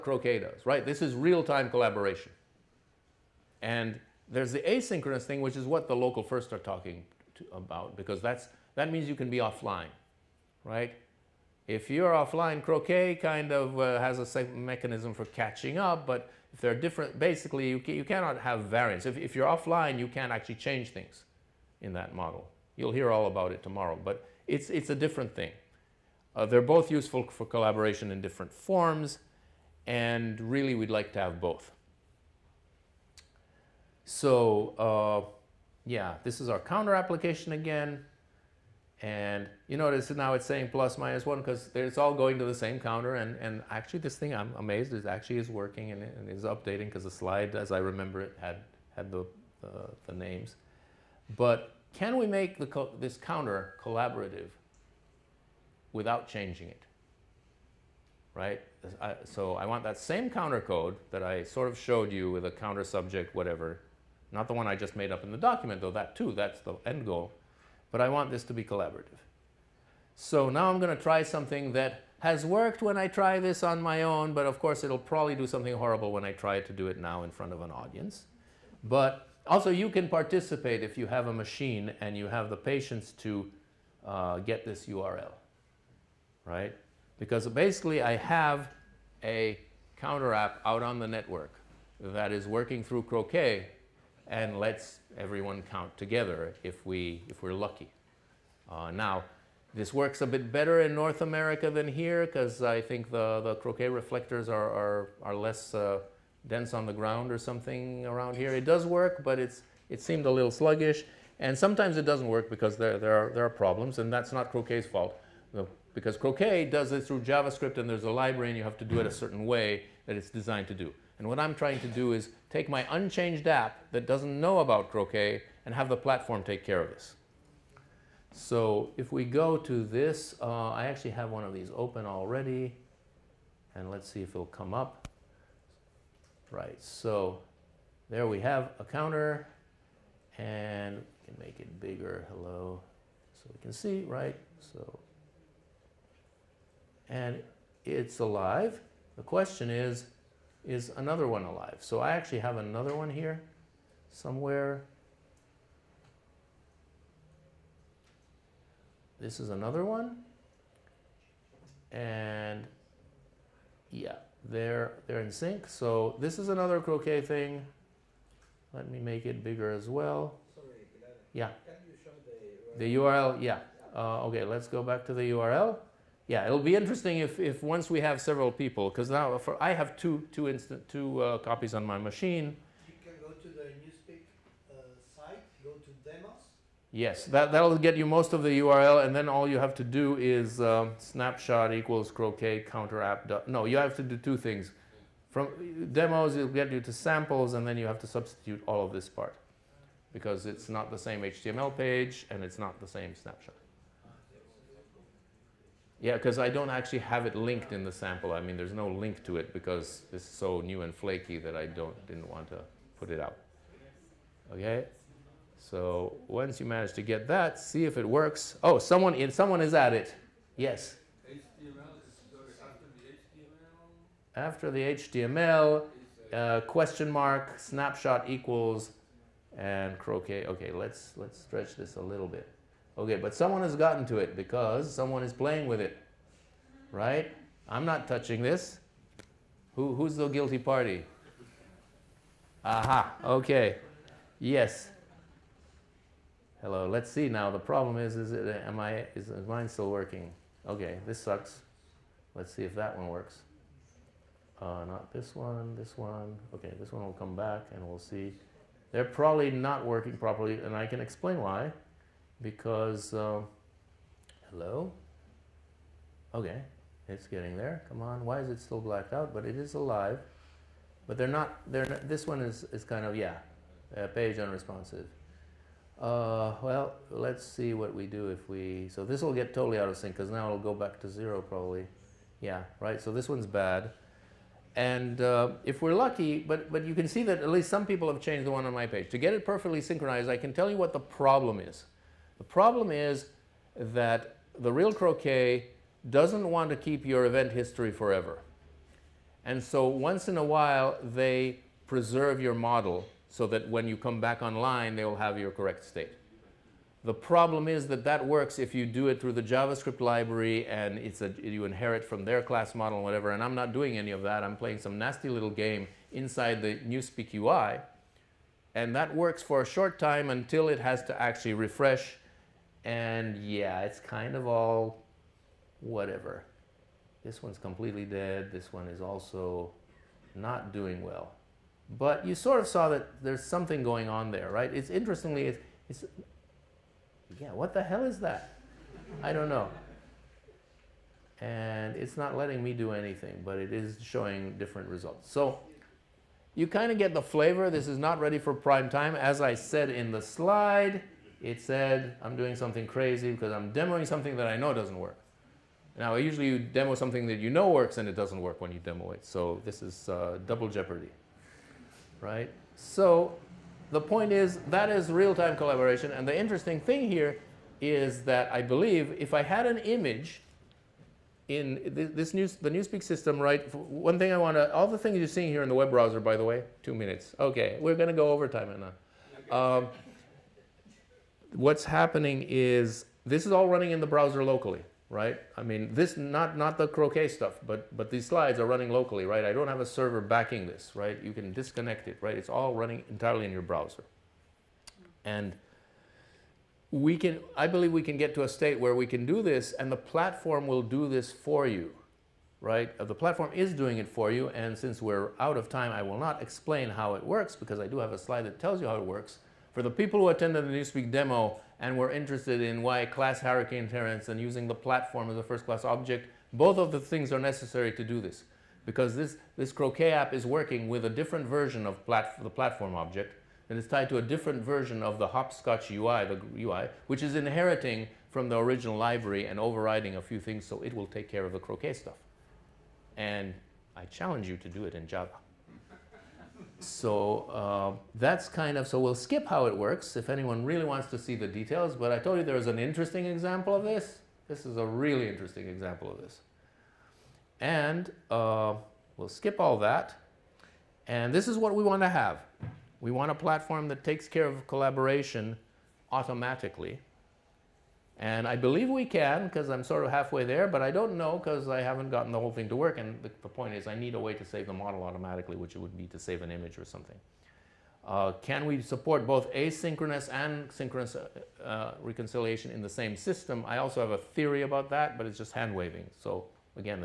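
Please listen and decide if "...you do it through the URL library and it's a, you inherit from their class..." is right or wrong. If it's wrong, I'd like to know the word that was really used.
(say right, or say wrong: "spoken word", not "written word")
wrong: "JavaScript", not "URL".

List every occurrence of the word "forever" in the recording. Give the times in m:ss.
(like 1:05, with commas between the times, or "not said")
4:57.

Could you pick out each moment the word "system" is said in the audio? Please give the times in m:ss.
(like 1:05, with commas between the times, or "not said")
6:13, 7:53.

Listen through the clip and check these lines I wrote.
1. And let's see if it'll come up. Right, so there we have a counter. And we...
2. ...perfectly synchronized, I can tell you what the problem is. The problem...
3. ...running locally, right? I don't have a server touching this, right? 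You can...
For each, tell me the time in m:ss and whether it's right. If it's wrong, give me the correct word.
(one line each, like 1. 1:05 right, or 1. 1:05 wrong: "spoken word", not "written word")
1. 2:13 right
2. 4:49 right
3. 6:28 wrong: "backing", not "touching".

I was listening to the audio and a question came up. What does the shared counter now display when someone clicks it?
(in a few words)
plus minus one.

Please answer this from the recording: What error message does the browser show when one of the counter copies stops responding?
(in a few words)
page unresponsive.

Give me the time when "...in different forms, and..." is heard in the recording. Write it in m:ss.
0:28.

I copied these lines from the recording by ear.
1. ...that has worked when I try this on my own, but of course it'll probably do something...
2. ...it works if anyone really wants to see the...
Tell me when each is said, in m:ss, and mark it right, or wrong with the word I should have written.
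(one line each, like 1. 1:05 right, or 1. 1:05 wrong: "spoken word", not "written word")
1. 1:11 right
2. 7:19 right.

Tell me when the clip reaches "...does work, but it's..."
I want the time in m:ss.
1:48.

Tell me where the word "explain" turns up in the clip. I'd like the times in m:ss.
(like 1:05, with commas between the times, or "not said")
4:20, 6:46.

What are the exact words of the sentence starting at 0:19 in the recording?
If, if you're offline, you can't actually change things in that model.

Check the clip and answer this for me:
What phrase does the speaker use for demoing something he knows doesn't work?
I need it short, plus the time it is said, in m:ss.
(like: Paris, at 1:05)
double jeopardy, at 6:00.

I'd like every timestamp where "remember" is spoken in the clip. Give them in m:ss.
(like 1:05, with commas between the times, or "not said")
0:47.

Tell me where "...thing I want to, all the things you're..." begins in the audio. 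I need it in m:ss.
6:14.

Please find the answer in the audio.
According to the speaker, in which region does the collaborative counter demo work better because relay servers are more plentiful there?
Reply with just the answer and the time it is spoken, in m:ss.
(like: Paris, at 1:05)
North America, at 1:40.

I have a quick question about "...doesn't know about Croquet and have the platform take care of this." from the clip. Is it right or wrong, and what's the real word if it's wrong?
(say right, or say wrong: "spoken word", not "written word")
right.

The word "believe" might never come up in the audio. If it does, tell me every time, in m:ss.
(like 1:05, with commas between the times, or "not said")
6:08, 6:37, 7:38.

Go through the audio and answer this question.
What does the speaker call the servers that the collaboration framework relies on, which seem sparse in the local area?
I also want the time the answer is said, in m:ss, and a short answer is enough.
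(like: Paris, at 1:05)
reflectors, at 1:43.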